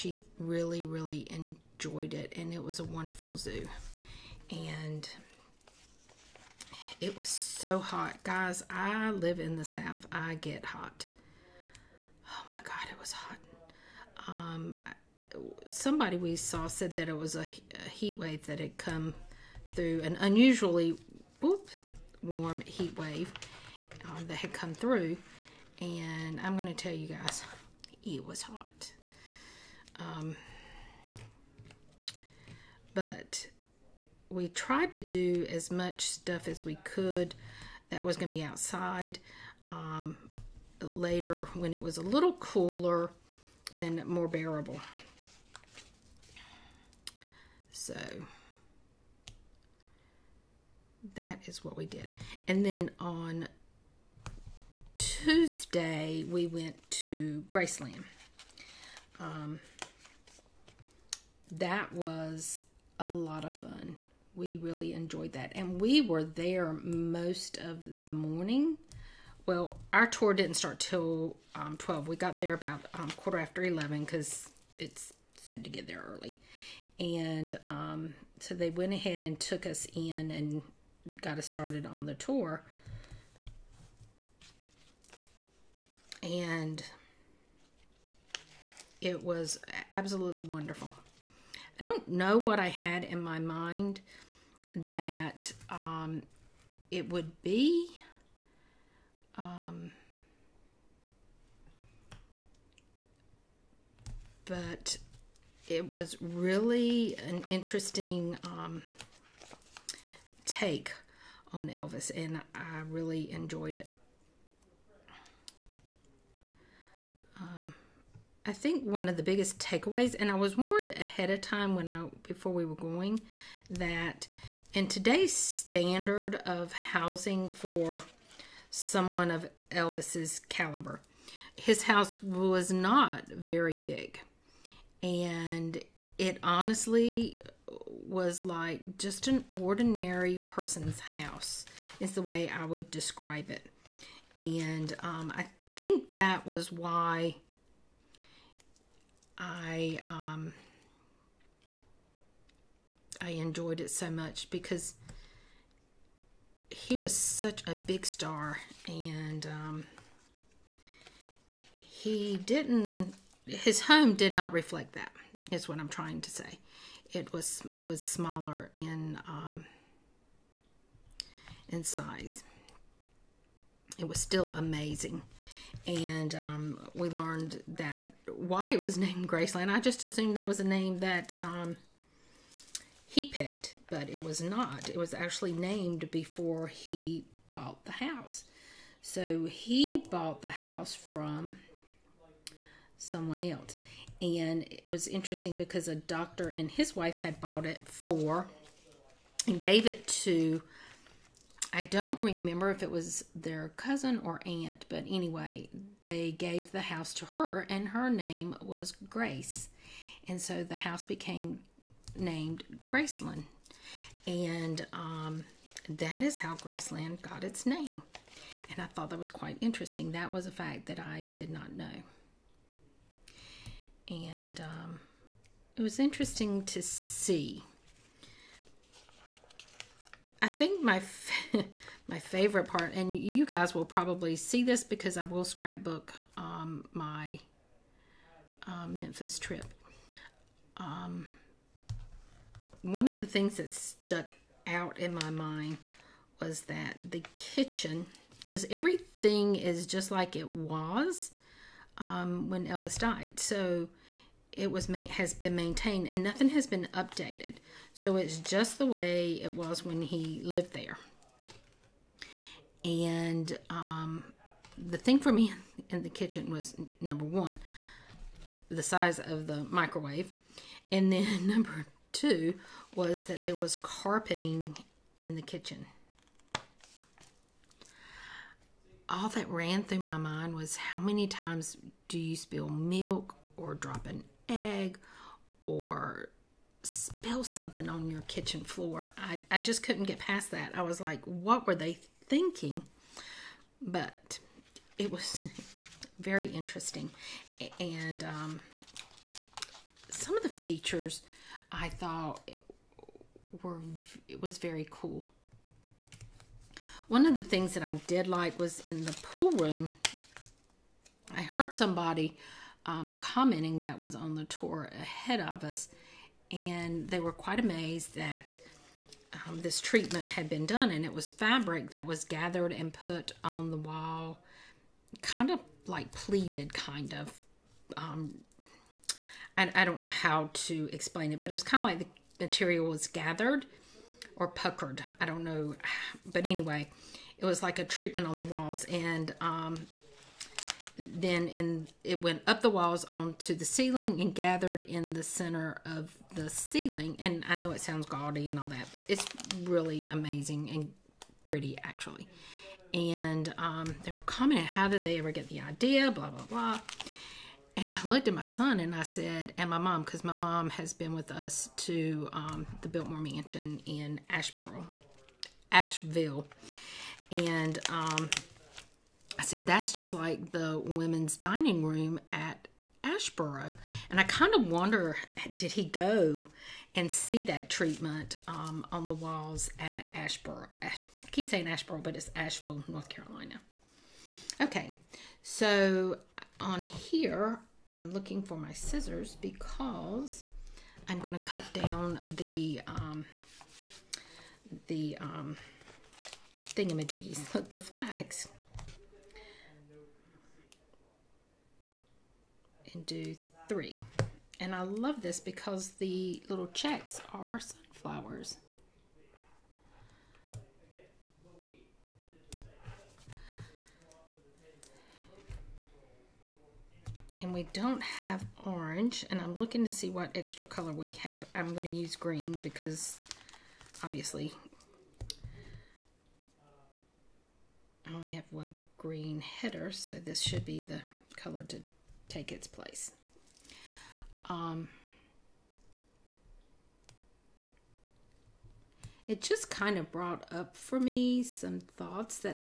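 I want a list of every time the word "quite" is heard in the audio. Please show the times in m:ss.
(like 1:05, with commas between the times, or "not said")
3:39, 5:17.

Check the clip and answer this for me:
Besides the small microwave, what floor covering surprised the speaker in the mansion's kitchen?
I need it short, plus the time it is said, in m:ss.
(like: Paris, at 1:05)
Carpeting, at 4:33.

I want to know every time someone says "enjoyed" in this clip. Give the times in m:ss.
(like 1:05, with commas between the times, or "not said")
0:01, 1:04, 1:53, 2:33.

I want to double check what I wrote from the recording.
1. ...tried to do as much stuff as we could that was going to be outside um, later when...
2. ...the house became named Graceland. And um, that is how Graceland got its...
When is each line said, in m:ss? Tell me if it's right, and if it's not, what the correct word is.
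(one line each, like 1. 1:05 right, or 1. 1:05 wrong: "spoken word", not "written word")
1. 0:34 right
2. 3:30 right.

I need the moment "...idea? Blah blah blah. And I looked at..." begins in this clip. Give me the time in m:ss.
5:55.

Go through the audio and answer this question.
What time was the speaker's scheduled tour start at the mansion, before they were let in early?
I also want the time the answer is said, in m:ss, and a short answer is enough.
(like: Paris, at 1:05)
12, at 1:11.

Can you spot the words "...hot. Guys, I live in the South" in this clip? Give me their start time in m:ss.
0:07.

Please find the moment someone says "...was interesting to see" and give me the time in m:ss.
3:45.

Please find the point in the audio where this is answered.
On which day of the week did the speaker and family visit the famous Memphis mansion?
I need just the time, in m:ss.
0:54.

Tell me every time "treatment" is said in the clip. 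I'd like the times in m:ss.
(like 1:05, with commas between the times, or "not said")
5:19, 5:37, 6:17.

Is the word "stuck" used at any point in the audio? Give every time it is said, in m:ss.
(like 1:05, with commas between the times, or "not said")
4:03.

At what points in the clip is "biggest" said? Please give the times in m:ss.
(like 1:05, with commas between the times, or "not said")
1:59.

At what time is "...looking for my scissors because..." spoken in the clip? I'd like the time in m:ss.
6:28.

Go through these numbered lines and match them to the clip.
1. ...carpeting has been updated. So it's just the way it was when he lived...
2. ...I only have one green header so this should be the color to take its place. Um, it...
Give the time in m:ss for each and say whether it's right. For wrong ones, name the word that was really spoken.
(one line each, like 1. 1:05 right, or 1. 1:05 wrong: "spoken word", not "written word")
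1. 4:16 wrong: "nothing", not "carpeting"
2. 7:08 right.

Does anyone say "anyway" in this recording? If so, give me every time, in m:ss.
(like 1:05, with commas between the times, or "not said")
3:25, 5:36.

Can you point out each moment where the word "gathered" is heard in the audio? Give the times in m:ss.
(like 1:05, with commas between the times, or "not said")
5:22, 5:33, 5:44.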